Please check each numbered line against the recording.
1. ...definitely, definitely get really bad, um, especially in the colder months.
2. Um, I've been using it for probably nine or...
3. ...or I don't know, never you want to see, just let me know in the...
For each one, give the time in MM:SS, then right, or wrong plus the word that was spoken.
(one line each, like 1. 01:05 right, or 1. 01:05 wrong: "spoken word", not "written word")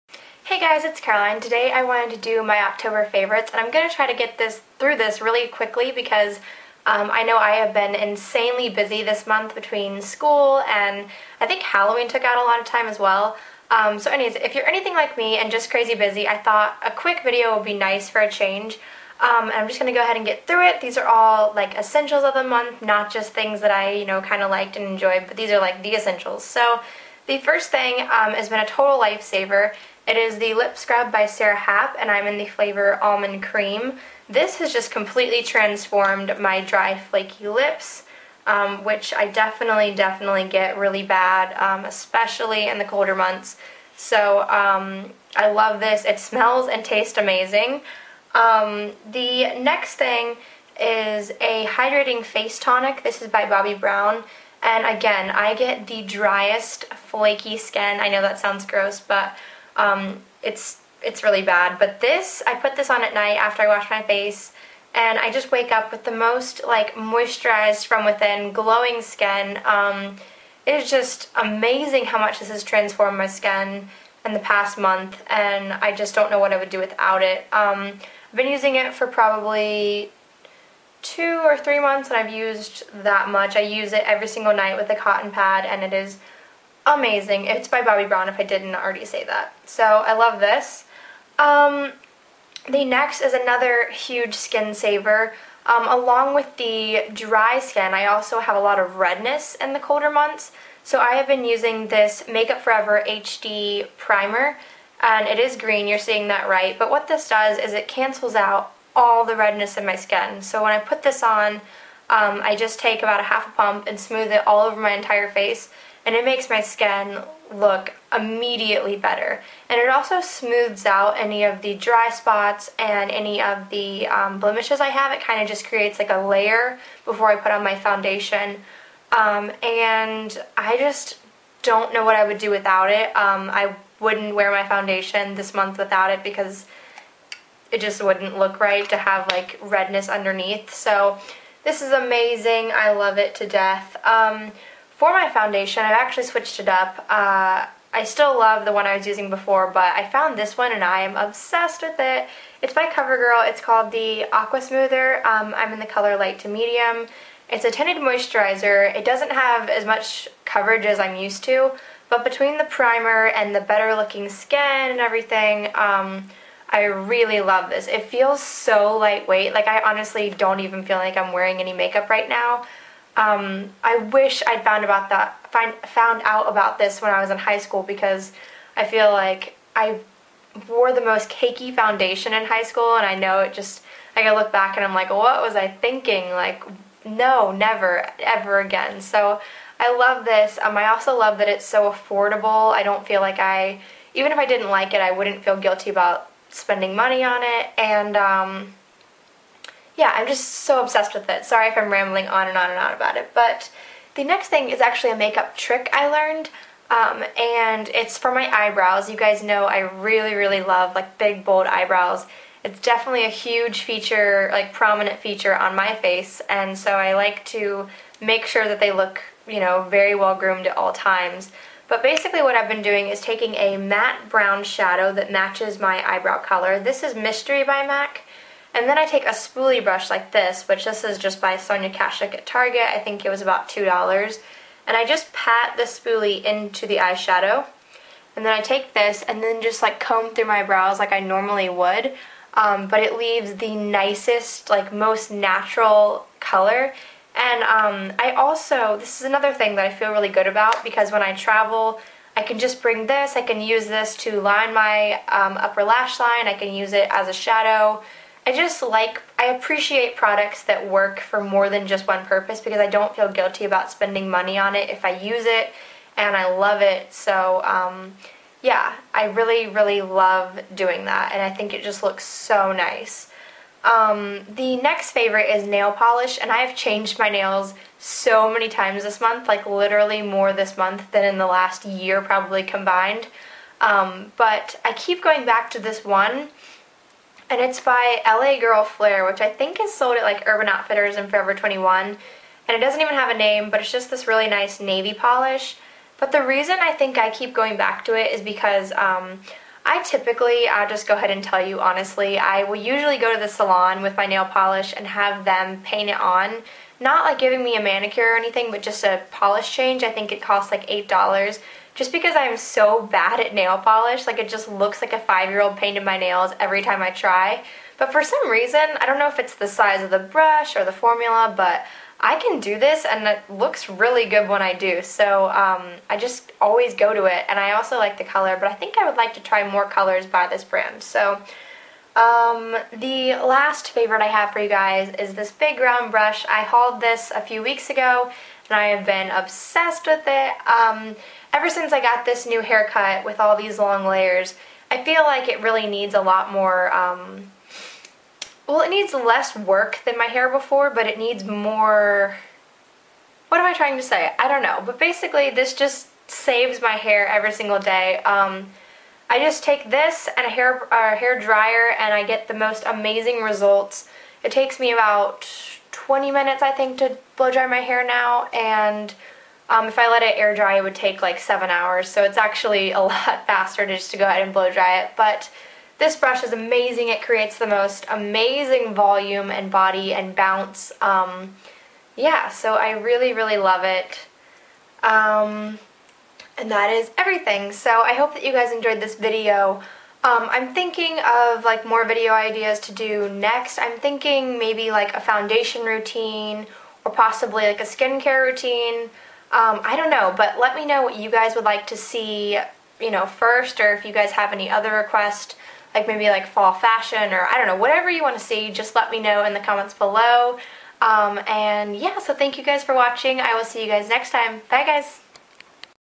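1. 00:39 right
2. 01:17 wrong: "two", not "nine"
3. 06:47 wrong: "whatever", not "never".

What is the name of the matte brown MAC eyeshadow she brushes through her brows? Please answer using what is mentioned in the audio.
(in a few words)
Mystery.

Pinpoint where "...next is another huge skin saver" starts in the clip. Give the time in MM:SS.
01:32.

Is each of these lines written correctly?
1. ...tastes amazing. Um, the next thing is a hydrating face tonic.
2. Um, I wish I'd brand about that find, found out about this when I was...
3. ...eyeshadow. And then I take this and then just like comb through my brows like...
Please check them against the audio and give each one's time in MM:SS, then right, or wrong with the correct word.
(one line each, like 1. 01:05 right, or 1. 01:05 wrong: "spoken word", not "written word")
1. 00:46 right
2. 02:53 wrong: "found", not "brand"
3. 03:56 right.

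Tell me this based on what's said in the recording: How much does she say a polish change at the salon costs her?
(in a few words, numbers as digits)
$8.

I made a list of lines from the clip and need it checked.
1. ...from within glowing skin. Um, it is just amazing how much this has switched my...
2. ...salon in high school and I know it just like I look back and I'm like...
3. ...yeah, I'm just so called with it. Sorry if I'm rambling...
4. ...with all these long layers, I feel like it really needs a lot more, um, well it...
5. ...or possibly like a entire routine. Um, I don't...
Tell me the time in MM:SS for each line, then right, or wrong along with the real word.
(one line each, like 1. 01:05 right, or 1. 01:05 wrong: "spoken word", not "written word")
1. 01:07 wrong: "transformed", not "switched"
2. 03:01 wrong: "foundation", not "salon"
3. 03:19 wrong: "obsessed", not "called"
4. 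05:43 right
5. 06:37 wrong: "skincare", not "entire".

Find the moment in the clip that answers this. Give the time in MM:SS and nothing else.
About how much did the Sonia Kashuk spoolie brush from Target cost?
03:53.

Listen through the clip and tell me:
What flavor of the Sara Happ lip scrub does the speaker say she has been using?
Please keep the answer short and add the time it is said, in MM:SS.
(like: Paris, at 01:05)
Almond Cream, at 00:33.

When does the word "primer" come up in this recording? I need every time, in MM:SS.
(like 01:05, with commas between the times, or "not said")
01:43, 02:42.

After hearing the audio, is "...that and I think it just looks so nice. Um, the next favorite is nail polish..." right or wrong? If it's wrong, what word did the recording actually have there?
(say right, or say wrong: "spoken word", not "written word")
right.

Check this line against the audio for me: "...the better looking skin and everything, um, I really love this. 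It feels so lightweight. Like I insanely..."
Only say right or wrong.
wrong.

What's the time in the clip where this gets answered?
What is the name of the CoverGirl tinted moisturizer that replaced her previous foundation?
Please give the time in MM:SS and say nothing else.
02:34.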